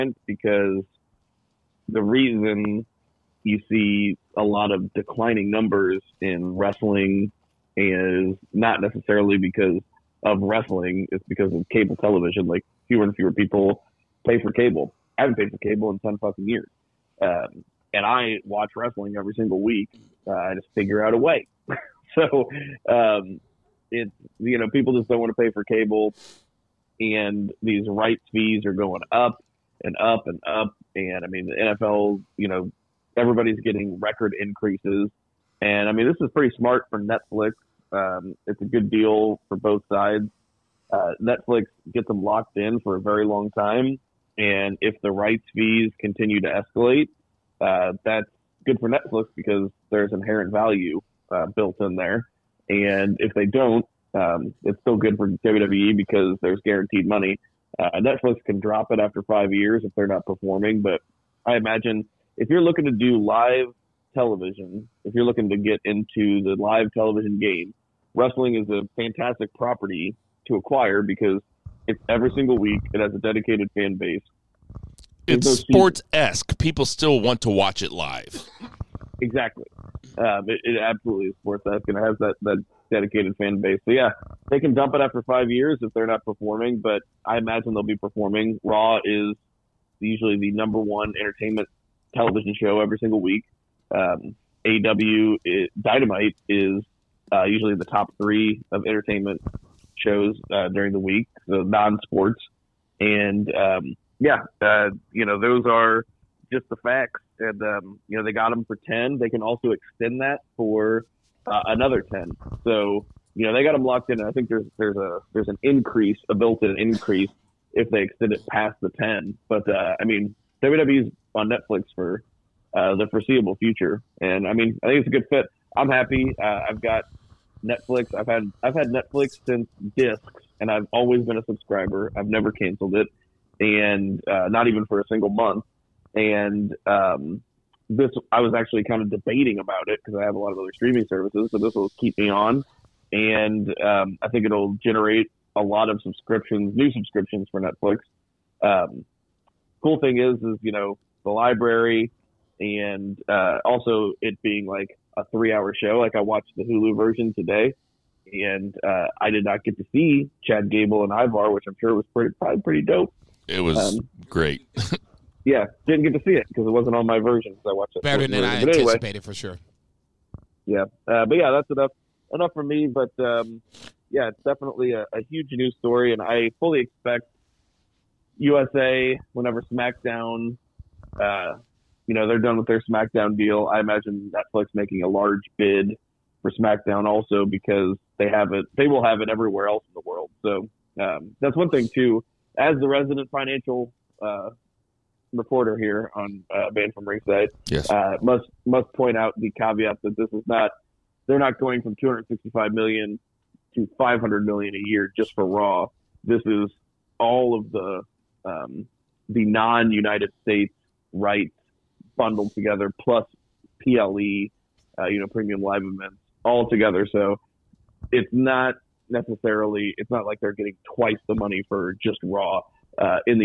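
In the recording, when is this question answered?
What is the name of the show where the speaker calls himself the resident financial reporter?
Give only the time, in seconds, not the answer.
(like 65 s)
196 s.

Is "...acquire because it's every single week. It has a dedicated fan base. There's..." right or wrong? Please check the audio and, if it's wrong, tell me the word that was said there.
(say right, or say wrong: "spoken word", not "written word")
right.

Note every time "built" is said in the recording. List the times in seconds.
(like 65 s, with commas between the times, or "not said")
51 s, 116 s.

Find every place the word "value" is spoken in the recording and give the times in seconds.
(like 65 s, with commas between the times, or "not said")
50 s.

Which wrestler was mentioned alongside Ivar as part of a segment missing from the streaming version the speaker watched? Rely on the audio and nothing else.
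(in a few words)
Chad Gable.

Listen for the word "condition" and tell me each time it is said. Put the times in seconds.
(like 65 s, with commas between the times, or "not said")
not said.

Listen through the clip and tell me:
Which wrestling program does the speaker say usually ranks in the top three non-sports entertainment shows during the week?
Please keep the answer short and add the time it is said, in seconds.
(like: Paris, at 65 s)
AEW Dynamite, at 94 s.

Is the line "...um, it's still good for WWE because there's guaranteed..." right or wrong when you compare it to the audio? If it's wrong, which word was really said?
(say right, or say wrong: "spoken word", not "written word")
right.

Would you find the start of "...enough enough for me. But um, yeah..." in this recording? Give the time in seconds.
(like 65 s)
171 s.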